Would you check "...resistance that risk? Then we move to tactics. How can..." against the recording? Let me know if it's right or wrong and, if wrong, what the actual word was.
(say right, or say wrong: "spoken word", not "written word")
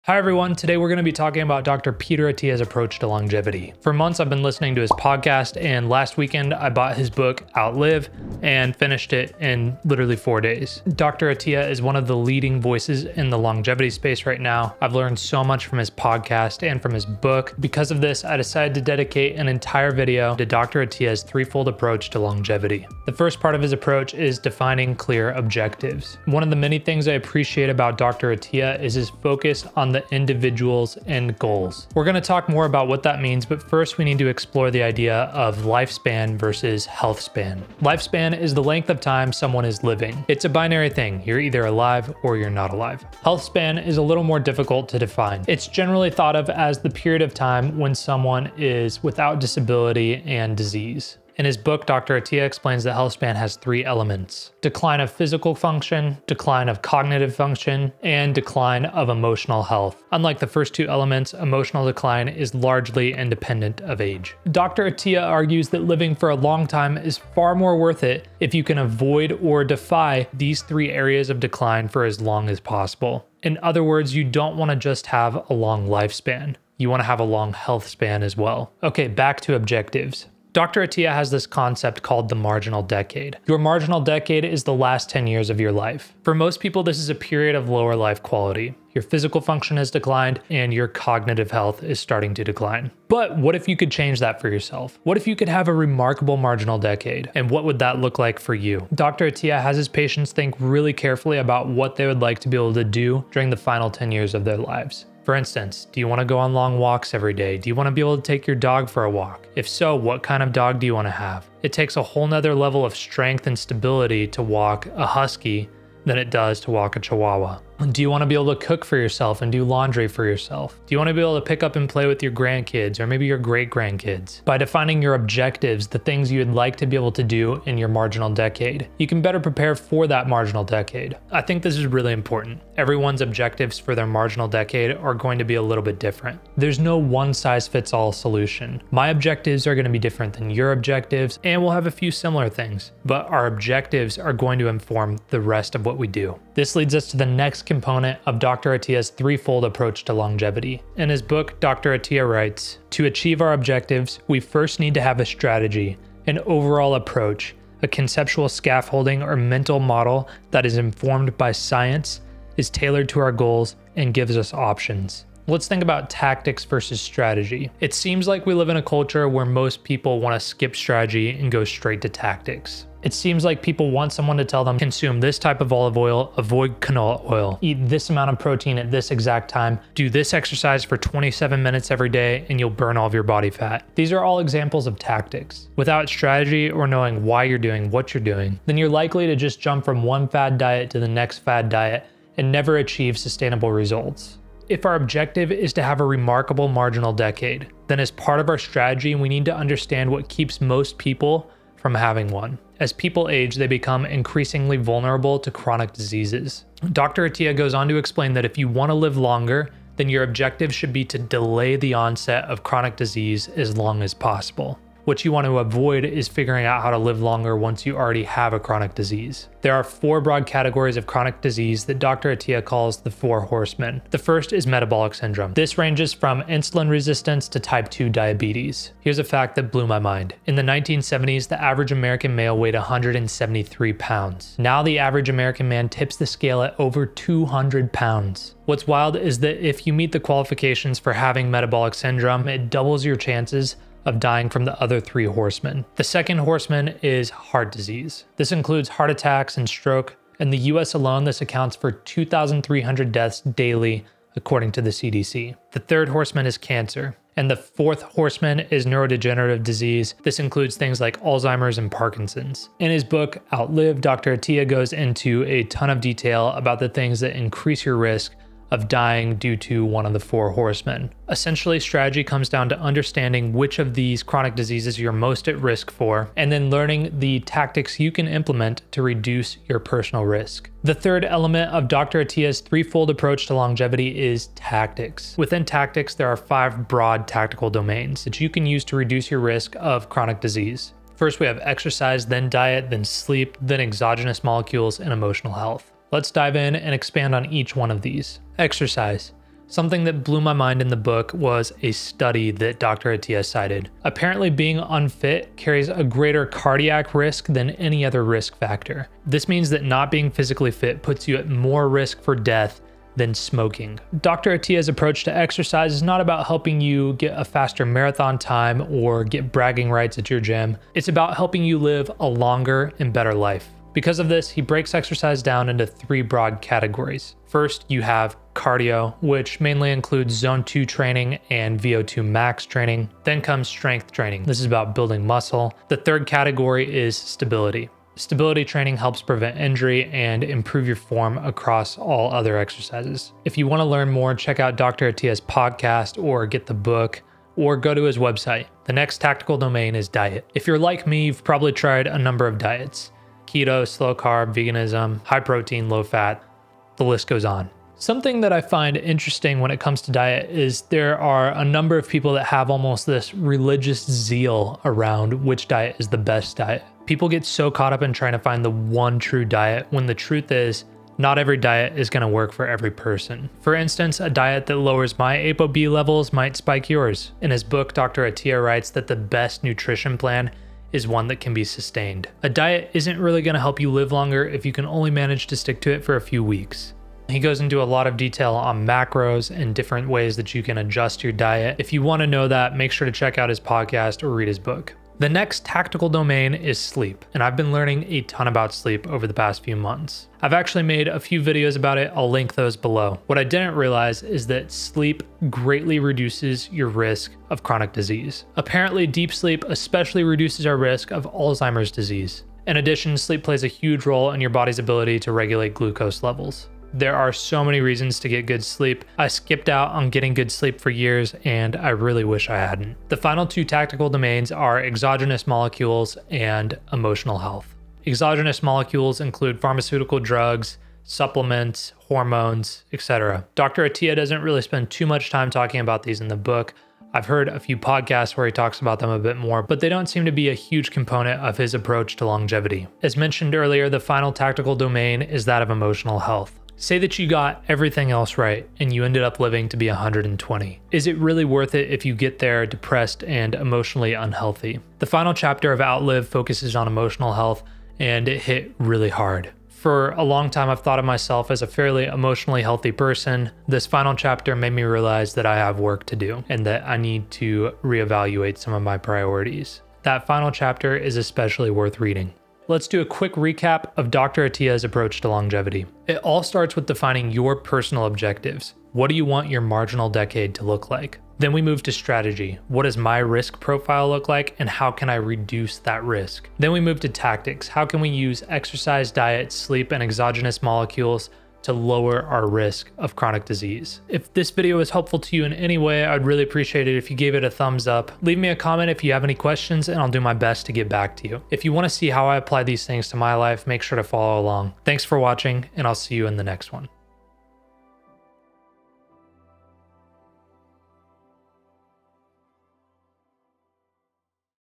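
wrong: "reduce", not "resistance".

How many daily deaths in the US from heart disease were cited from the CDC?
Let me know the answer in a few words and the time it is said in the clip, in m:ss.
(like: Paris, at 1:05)
2,300, at 4:11.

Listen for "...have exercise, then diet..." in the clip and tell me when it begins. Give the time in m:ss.
4:51.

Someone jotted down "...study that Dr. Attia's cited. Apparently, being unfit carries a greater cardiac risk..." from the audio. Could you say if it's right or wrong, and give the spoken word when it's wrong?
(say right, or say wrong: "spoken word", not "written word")
right.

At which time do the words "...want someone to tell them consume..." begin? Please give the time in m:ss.
2:53.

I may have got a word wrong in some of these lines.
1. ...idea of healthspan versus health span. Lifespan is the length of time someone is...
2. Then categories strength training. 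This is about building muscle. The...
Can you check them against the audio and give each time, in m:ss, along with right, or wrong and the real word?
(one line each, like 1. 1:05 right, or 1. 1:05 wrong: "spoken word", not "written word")
1. 0:34 wrong: "lifespan", not "healthspan"
2. 5:33 wrong: "comes", not "categories".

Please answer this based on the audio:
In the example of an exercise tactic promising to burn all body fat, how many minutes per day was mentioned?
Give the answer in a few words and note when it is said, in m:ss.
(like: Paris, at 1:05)
27, at 3:00.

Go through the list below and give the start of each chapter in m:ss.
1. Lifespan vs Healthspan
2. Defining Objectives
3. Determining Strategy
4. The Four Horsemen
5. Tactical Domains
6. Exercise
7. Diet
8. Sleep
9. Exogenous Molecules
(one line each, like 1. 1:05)
1. 0:22
2. 1:18
3. 2:26
4. 3:22
5. 4:40
6. 4:58
7. 5:48
8. 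6:35
9. 7:03.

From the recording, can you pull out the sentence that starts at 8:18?
Leave me a comment if you have any questions and I'll do my best to get back to you.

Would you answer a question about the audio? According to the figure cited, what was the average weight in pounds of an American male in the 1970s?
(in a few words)
173.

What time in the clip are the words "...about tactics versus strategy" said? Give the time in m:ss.
2:45.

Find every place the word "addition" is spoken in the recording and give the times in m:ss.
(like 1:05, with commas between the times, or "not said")
6:52.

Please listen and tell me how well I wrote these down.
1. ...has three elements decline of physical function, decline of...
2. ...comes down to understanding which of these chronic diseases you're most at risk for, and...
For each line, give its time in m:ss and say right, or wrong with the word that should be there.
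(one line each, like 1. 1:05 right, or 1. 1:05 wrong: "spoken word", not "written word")
1. 0:53 right
2. 4:32 right.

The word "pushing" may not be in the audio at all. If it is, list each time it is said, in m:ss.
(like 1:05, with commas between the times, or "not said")
not said.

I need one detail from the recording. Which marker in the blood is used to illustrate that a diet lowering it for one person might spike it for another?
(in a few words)
ApoB.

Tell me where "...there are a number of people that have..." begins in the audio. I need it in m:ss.
6:00.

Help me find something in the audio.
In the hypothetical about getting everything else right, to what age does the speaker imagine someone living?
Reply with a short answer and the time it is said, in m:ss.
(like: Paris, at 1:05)
120, at 7:29.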